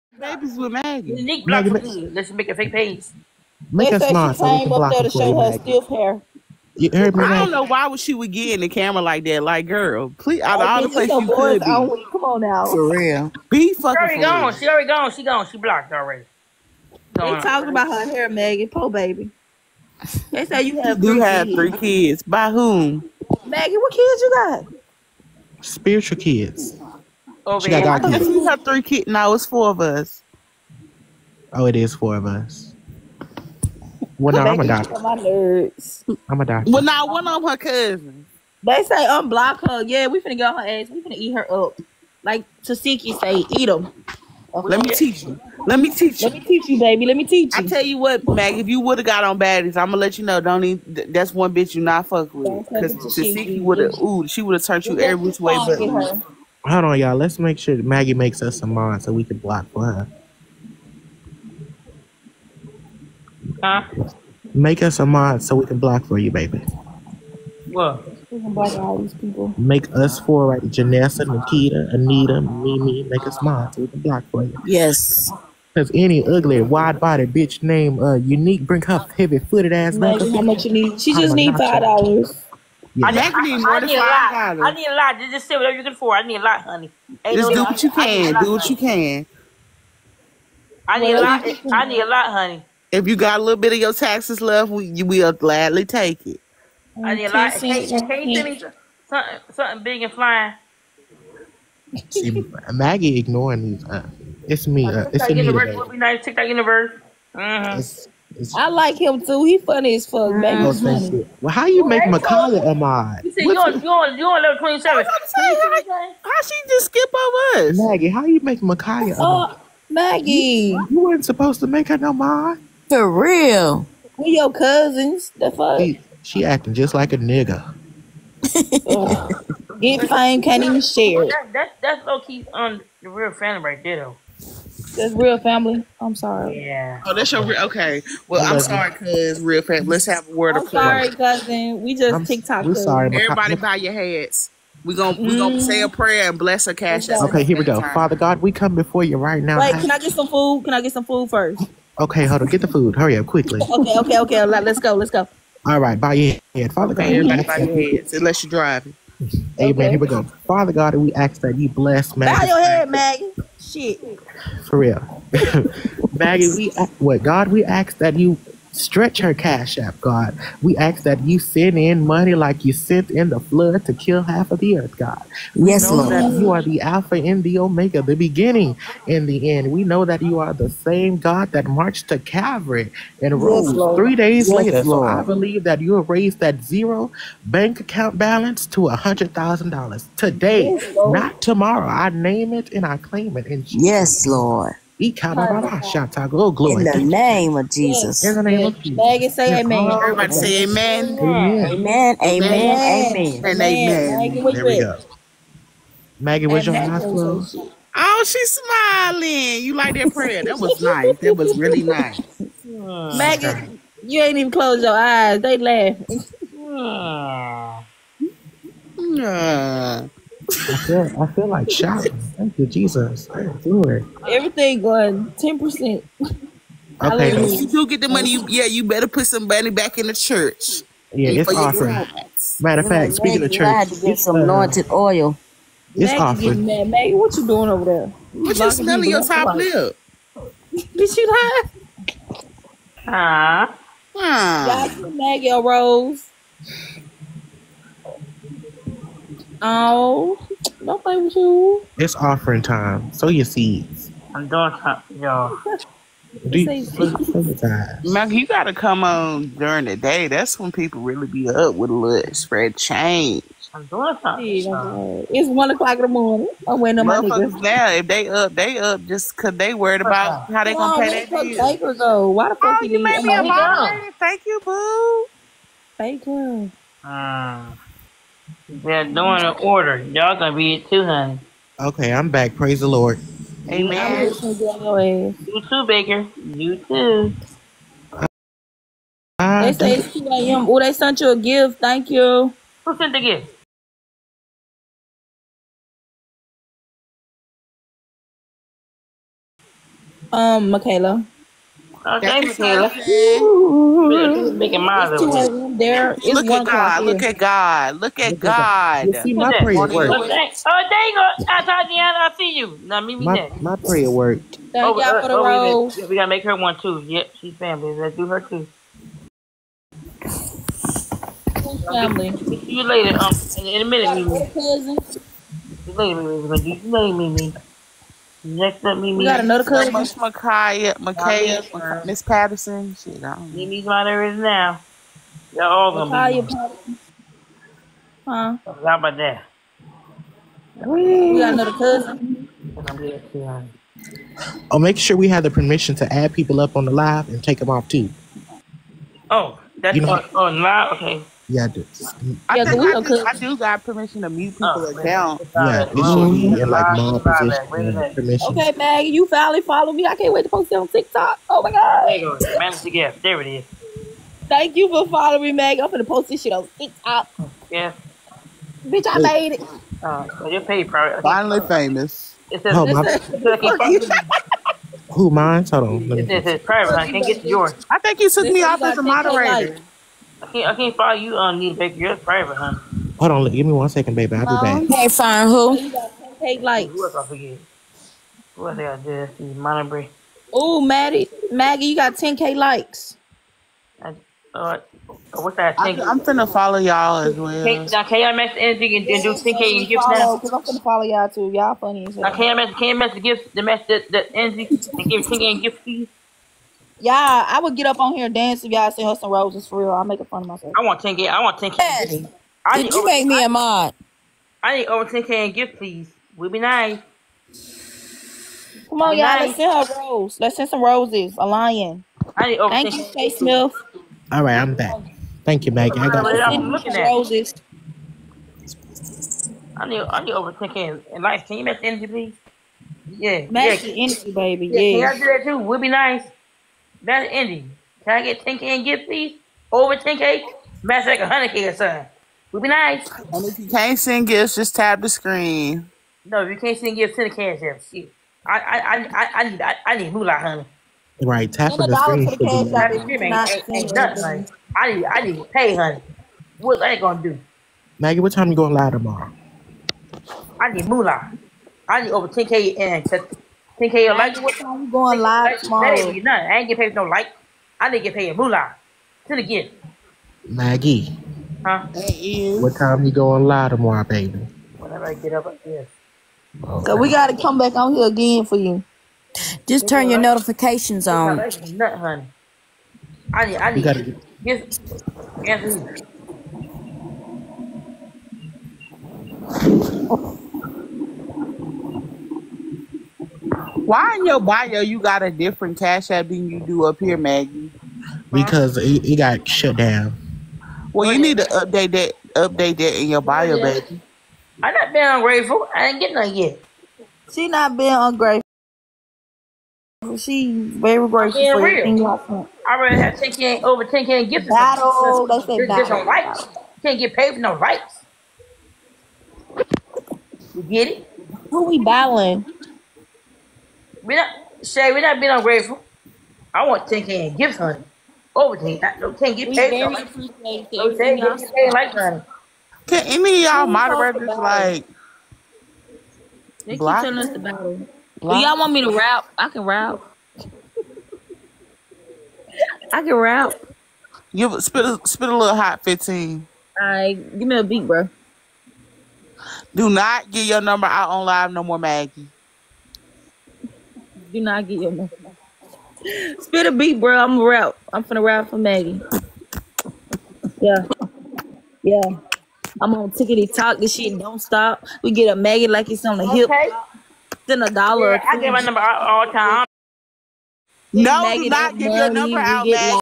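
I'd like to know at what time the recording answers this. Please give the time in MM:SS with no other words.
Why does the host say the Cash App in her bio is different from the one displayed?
08:19.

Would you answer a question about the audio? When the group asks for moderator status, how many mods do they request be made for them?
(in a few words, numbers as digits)
4.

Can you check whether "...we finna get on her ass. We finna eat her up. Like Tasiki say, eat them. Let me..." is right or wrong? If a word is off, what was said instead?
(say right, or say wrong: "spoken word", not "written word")
right.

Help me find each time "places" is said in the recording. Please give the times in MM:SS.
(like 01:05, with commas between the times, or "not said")
00:10.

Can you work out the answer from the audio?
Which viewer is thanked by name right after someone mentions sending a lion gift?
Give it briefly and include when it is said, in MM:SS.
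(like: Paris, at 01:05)
Shay Smith, at 07:03.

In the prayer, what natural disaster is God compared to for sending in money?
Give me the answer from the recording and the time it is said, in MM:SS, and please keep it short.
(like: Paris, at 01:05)
The flood, at 02:53.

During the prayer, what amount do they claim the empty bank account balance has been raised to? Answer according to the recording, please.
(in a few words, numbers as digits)
$100,000.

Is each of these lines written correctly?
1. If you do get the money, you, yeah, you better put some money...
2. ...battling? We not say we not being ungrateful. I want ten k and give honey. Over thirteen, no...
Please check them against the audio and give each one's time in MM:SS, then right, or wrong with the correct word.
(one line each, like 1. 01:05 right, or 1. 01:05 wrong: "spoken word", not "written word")
1. 03:47 right
2. 08:41 wrong: "ten", not "thirteen".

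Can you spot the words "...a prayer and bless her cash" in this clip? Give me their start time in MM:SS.
02:25.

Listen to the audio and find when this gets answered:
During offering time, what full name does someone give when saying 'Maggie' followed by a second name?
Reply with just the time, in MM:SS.
04:05.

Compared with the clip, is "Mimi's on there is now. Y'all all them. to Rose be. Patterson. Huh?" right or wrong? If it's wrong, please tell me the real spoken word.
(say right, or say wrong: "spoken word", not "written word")
wrong: "Micaiah", not "Rose".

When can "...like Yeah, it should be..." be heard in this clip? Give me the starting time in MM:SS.
05:54.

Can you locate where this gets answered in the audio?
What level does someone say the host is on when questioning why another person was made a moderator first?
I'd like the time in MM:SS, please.
01:54.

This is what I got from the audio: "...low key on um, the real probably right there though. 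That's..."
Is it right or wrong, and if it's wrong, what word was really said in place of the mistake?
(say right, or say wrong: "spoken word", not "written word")
wrong: "family", not "probably".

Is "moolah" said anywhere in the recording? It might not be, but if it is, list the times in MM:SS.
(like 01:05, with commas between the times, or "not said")
07:30, 07:40, 07:48.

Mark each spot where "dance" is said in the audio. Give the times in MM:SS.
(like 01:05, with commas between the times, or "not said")
06:48.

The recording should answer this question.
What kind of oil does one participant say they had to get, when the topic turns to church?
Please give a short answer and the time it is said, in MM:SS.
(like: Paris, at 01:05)
Anointed oil, at 03:54.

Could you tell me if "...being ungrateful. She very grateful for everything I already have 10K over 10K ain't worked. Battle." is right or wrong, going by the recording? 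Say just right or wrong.
wrong.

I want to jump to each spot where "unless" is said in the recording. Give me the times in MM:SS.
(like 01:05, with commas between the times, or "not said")
02:38.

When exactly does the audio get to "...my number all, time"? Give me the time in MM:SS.
09:28.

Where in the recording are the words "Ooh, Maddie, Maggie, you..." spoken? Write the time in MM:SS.
06:30.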